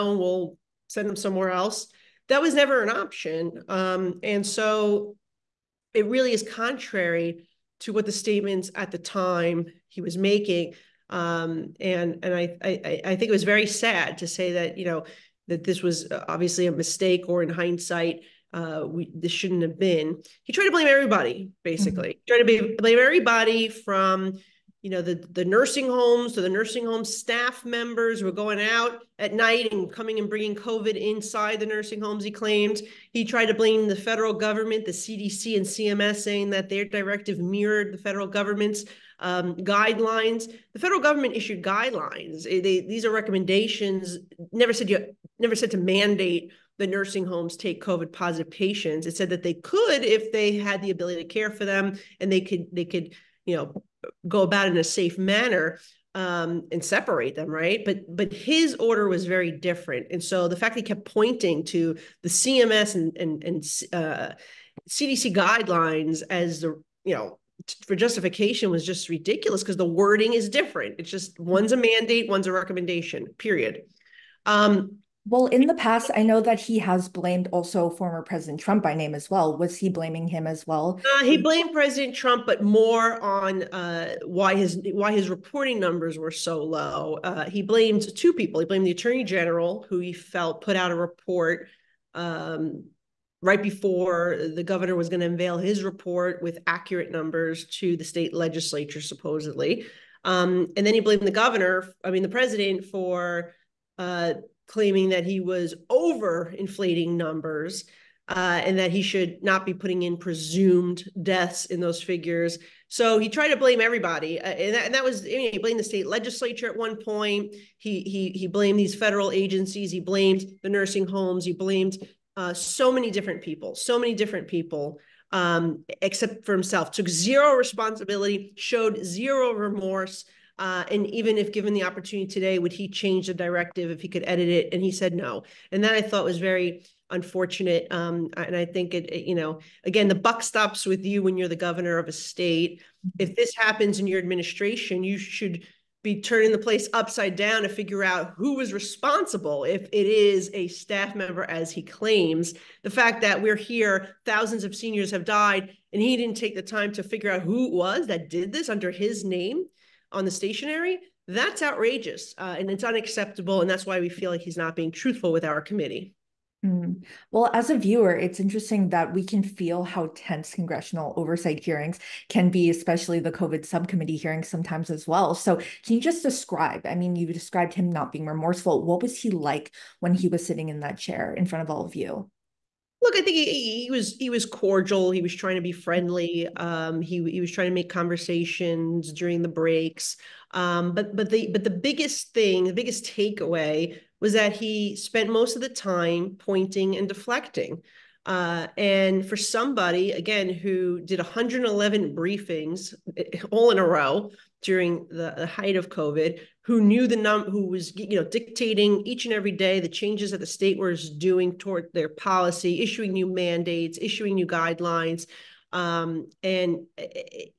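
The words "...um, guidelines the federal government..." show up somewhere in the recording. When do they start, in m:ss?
0:39.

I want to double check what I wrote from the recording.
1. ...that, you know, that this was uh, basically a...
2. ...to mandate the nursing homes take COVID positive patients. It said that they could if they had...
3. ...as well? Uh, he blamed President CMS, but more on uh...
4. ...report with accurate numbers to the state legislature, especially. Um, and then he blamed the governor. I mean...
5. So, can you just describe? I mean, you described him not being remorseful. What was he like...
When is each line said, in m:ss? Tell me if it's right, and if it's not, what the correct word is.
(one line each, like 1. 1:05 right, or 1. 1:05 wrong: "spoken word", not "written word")
1. 0:14 wrong: "obviously", not "basically"
2. 0:45 right
3. 1:20 wrong: "Trump", not "CMS"
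4. 1:35 wrong: "supposedly", not "especially"
5. 2:55 right.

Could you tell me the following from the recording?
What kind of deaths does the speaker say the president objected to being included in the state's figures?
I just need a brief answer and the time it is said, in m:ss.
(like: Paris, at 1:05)
Presumed deaths, at 1:50.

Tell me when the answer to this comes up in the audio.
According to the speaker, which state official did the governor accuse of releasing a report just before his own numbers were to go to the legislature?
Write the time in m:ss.
1:28.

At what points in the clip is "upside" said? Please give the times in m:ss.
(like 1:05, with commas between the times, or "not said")
2:26.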